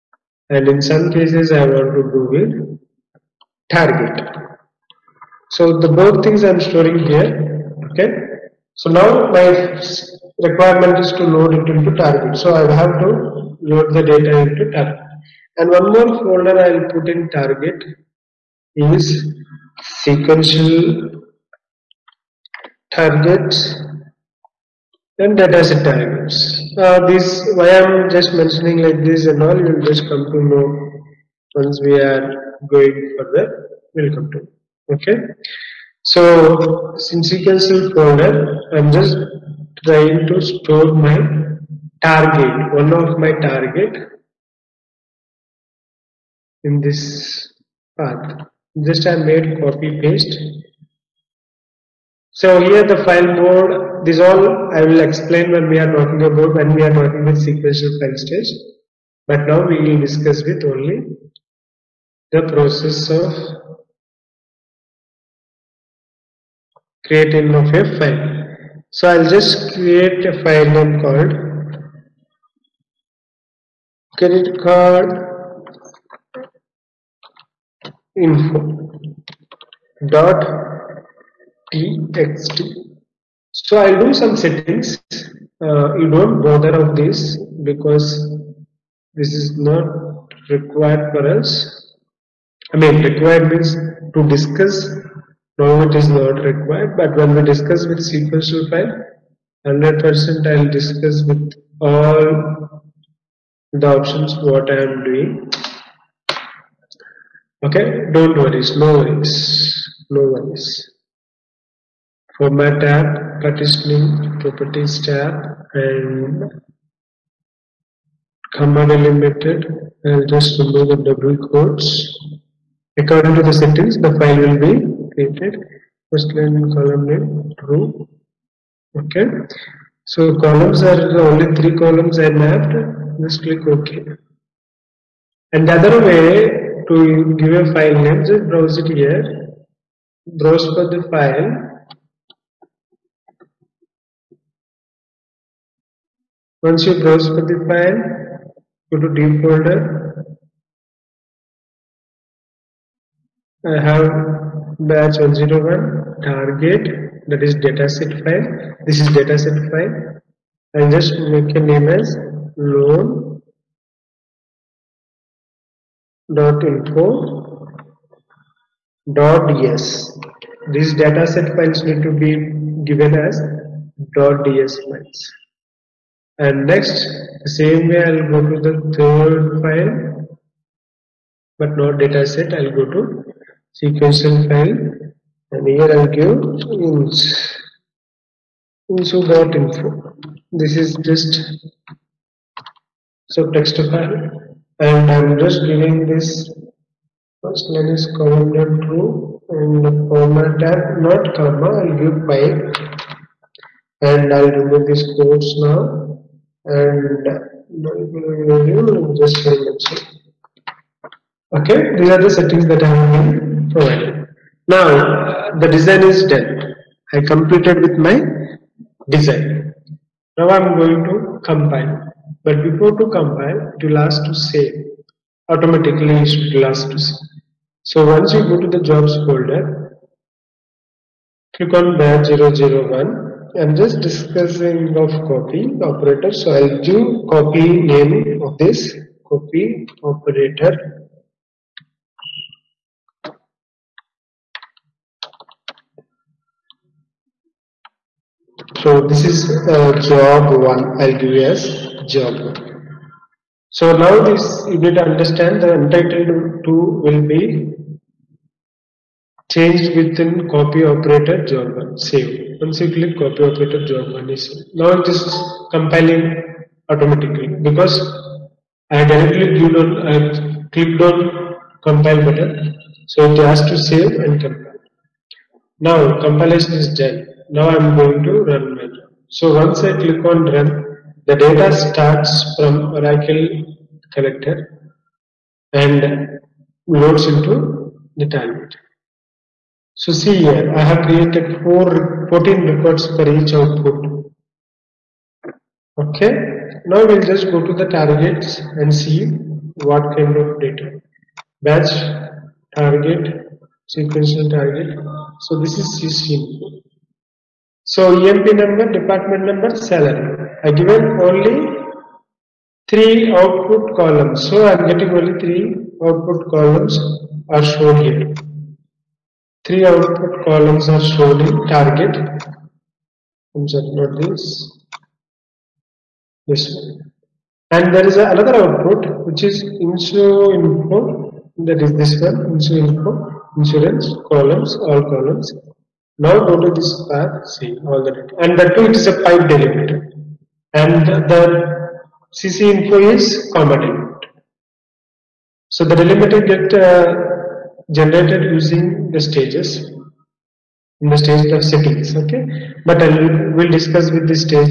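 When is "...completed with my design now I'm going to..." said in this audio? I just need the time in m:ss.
3:37.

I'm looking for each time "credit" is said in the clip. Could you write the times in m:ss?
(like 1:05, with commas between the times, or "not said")
1:14.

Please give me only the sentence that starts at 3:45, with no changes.
Automatically it will ask to save.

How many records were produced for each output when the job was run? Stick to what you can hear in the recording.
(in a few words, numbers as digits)
14.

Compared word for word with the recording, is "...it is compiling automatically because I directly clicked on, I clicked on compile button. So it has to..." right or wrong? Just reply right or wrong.
right.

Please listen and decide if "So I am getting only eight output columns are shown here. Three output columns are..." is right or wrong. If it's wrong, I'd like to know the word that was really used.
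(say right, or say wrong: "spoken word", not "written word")
wrong: "three", not "eight".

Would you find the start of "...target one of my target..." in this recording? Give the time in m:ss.
0:42.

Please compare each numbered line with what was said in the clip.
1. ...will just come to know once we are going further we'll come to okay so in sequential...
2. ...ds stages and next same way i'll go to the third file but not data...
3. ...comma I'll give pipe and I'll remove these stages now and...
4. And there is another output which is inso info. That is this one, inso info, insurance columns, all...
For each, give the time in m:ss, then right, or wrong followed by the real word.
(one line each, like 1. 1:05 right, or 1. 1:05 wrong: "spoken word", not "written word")
1. 0:29 right
2. 2:54 wrong: "files", not "stages"
3. 3:21 wrong: "quotes", not "stages"
4. 5:27 right.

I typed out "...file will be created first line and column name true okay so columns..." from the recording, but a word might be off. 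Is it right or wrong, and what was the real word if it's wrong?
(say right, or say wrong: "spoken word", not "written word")
right.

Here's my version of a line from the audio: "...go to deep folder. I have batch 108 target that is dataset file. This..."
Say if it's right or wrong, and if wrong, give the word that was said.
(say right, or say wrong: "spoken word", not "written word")
wrong: "101", not "108".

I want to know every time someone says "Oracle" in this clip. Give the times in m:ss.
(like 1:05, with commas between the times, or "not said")
4:42.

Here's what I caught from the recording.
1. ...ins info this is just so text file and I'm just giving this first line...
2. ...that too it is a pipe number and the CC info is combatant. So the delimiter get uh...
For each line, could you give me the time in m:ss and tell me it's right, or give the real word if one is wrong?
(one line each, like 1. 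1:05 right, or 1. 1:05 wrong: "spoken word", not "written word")
1. 3:06 right
2. 5:38 wrong: "delimiter", not "number".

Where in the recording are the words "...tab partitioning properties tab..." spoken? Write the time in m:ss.
1:52.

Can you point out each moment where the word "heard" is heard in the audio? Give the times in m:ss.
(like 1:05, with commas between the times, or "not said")
not said.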